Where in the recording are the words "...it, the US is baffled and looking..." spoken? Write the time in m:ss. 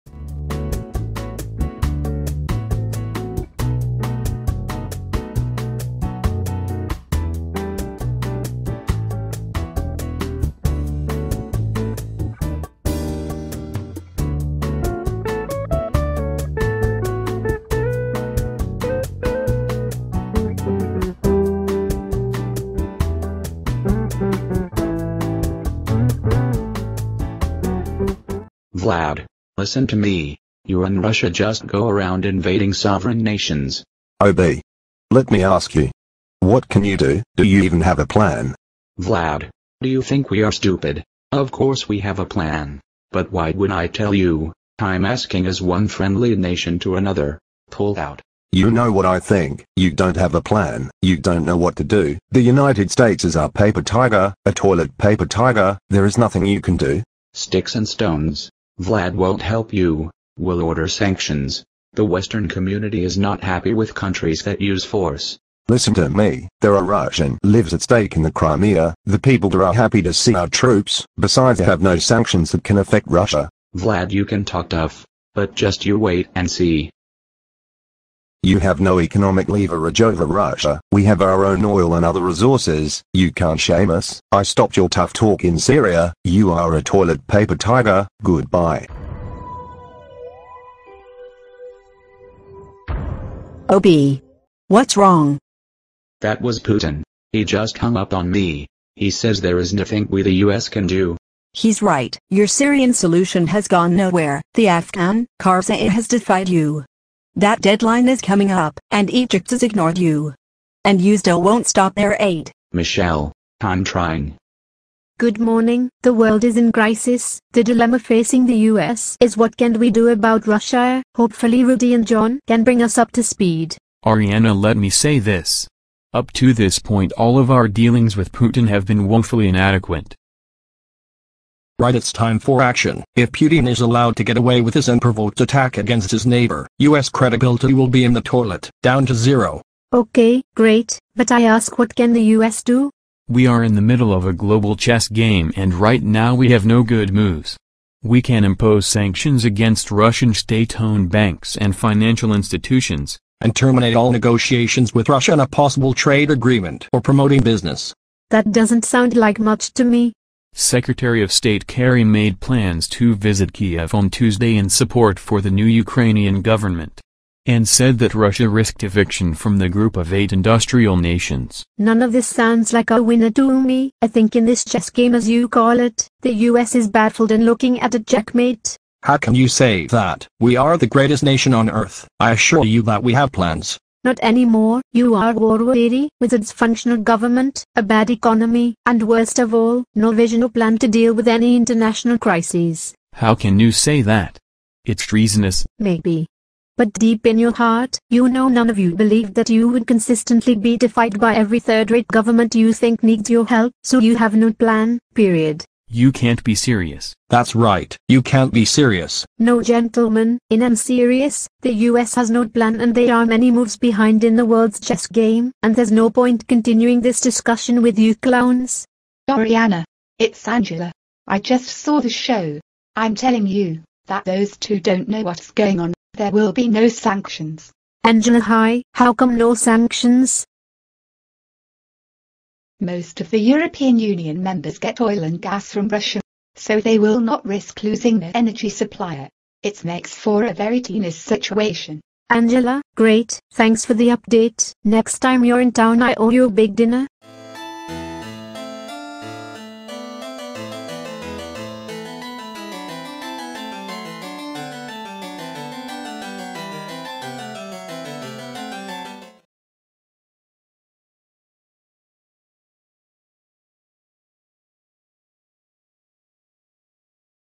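2:55.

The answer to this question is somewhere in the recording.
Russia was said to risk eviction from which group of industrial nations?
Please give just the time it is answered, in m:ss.
2:49.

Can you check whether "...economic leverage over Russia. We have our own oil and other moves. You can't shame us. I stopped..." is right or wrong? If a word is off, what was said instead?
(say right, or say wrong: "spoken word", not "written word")
wrong: "resources", not "moves".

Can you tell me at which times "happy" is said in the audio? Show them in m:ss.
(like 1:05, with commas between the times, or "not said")
1:03, 1:09.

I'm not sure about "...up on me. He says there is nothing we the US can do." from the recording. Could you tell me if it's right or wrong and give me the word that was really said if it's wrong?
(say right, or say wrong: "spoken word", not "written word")
right.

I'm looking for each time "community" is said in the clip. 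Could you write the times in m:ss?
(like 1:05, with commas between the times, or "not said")
1:02.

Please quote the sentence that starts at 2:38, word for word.
That doesn't sound like much to me.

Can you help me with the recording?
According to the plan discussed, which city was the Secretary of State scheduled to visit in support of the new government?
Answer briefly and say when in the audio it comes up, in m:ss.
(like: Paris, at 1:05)
Kiev, at 2:43.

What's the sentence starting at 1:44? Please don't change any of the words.
The Afghan Karzai has defied you.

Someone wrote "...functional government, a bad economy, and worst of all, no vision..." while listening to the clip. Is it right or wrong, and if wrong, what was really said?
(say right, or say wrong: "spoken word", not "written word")
right.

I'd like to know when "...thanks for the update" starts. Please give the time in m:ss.
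4:03.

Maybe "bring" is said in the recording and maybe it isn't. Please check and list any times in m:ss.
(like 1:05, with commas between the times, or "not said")
2:02.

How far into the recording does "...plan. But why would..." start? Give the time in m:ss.
0:42.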